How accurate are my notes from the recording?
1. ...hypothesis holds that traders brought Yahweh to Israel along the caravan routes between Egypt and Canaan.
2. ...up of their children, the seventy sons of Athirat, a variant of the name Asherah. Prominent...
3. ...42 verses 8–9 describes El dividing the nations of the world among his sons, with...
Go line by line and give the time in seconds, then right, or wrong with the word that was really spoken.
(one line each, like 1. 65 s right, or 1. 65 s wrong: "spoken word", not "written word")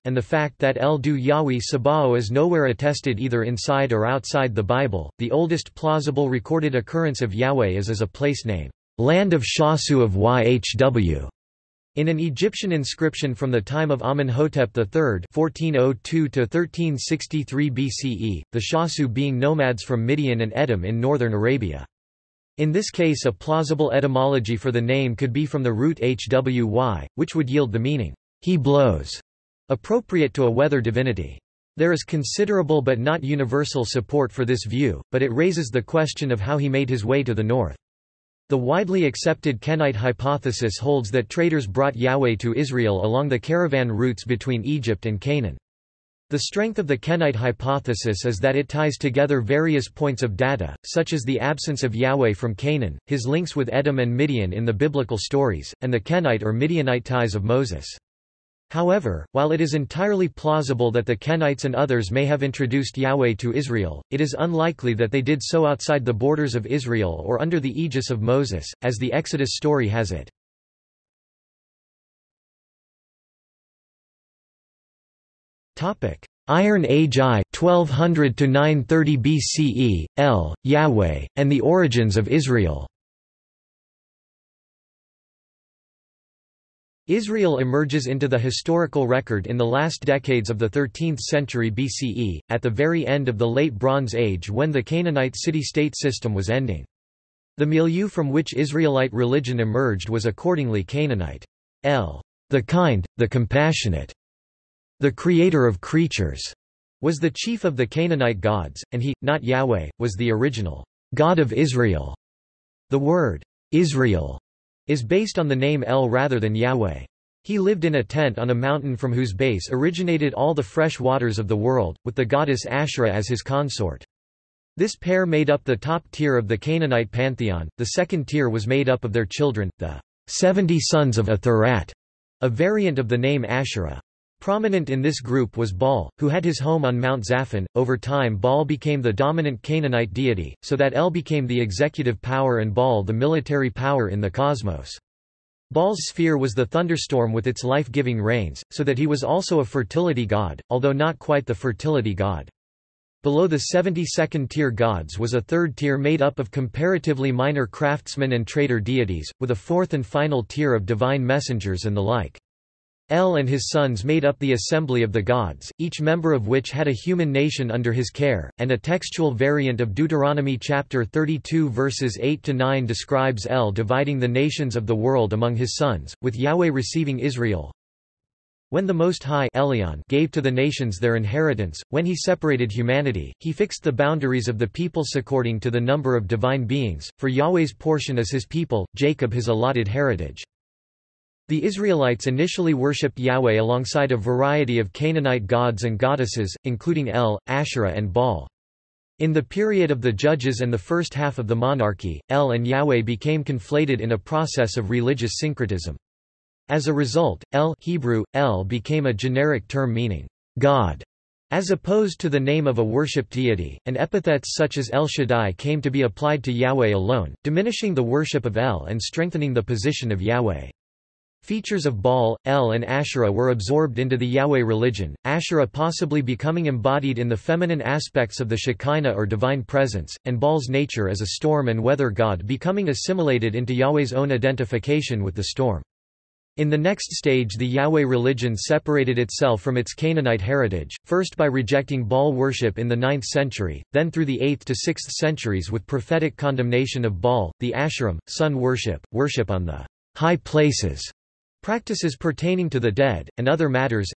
1. 39 s right
2. 128 s right
3. 171 s wrong: "32", not "42".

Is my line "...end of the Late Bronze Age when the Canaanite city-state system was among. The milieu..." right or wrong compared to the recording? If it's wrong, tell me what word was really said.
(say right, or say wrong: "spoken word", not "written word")
wrong: "ending", not "among".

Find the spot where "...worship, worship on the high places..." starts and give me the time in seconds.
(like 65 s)
248 s.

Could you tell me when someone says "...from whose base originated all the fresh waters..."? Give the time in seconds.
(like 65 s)
118 s.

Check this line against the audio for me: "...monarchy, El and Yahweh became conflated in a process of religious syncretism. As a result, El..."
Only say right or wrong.
right.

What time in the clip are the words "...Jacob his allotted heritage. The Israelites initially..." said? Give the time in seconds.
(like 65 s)
188 s.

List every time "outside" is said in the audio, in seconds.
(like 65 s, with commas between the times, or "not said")
4 s, 65 s.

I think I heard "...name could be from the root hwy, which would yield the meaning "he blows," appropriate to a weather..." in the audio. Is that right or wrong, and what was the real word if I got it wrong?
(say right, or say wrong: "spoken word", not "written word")
right.